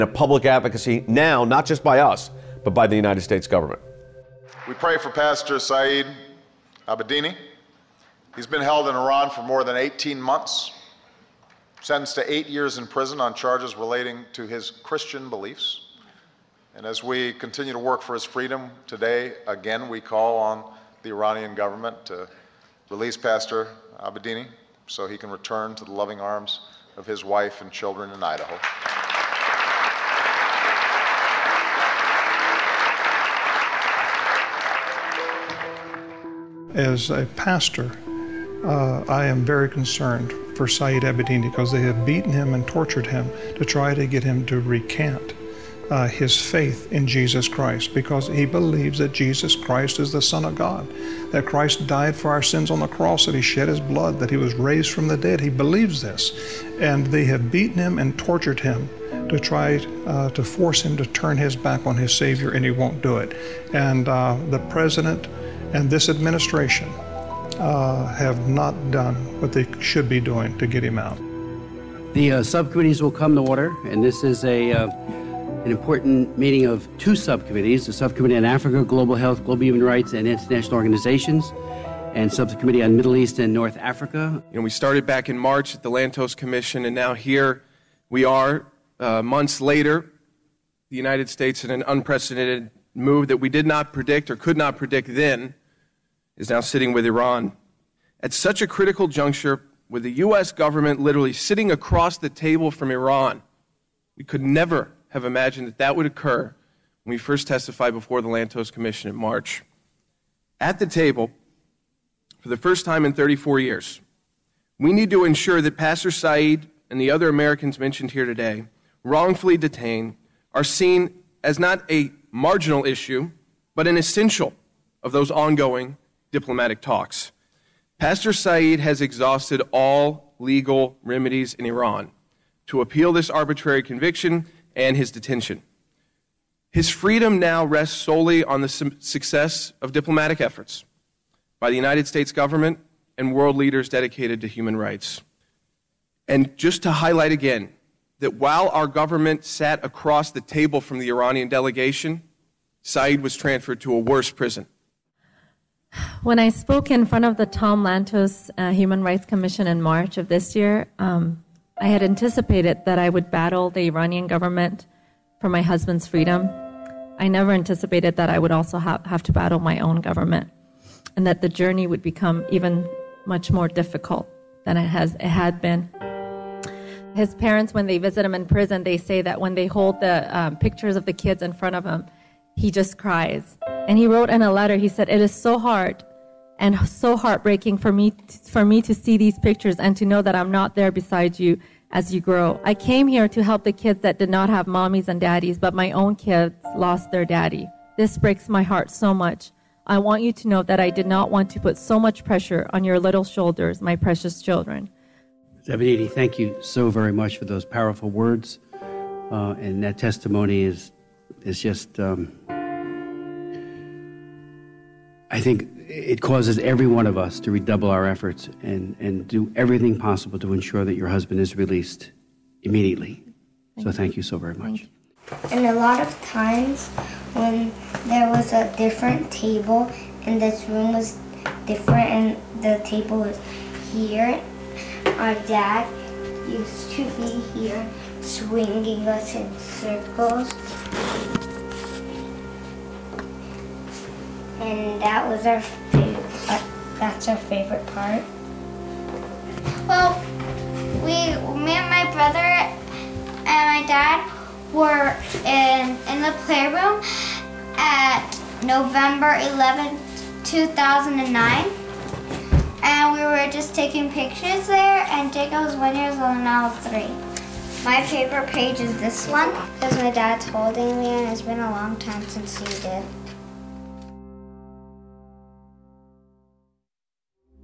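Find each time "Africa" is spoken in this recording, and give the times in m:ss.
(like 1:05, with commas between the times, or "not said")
1:18, 1:23.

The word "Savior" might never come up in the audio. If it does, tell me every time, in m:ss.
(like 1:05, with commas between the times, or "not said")
1:02.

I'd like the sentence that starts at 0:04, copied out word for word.
We pray for Pastor Saeed Abedini.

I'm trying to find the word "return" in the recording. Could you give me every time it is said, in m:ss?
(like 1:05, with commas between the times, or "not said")
0:25.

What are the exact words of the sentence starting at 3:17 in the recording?
This breaks my heart so much.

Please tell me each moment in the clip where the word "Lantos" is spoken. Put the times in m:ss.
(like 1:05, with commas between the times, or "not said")
1:25, 1:48, 2:37.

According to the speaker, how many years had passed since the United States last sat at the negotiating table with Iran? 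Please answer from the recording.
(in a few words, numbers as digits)
34.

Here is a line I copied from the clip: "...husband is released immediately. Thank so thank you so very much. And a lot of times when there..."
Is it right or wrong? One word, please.
right.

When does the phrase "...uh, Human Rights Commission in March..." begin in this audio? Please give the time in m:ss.
2:38.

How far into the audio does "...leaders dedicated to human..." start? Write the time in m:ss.
2:23.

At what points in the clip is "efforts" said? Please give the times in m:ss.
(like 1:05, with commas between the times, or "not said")
2:20, 3:38.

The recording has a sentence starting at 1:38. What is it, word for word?
At such a critical juncture, with the U.S.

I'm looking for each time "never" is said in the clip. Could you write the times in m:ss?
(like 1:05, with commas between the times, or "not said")
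1:44, 2:47.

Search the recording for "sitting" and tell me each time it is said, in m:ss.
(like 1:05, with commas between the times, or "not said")
1:36, 1:41.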